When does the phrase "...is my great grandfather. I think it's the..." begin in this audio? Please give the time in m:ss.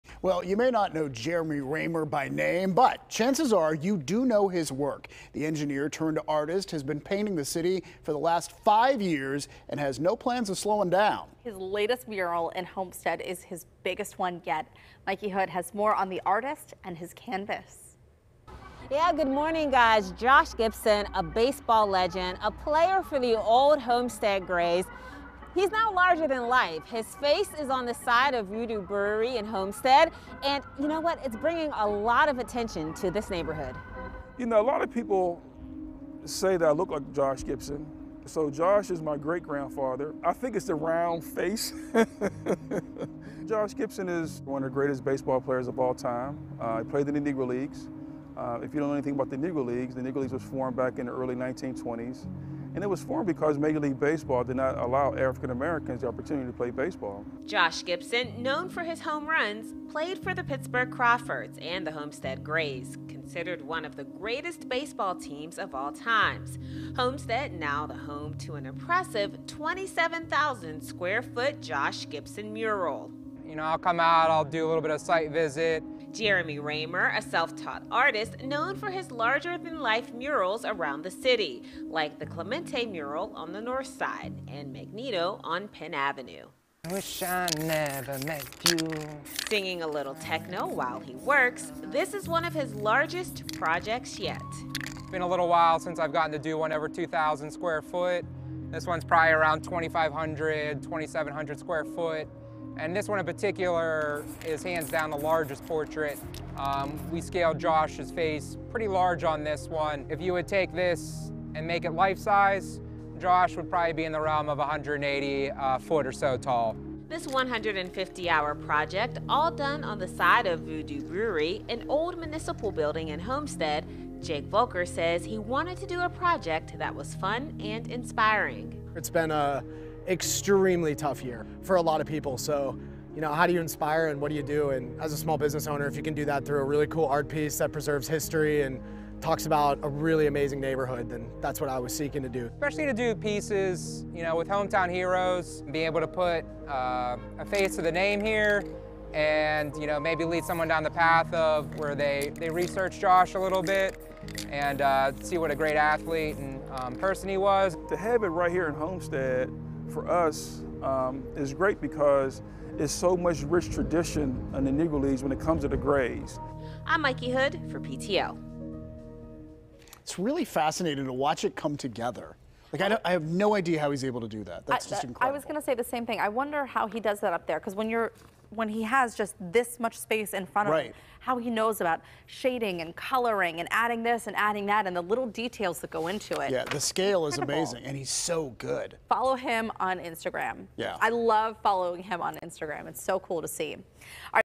0:38.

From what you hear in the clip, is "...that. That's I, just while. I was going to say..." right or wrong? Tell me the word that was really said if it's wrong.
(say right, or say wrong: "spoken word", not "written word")
wrong: "incredible", not "while".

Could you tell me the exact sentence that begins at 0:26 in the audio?
His face is on the side of Voodoo Brewery in Homestead.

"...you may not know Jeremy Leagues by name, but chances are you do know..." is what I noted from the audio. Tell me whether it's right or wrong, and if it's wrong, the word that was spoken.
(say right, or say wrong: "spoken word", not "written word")
wrong: "Raymer", not "Leagues".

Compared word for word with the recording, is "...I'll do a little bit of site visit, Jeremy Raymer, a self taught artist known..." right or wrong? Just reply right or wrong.
right.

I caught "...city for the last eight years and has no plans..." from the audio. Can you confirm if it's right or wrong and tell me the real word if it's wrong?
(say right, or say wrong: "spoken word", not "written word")
wrong: "five", not "eight".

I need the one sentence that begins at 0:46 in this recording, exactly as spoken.
Uh, he played in the Negro Leagues.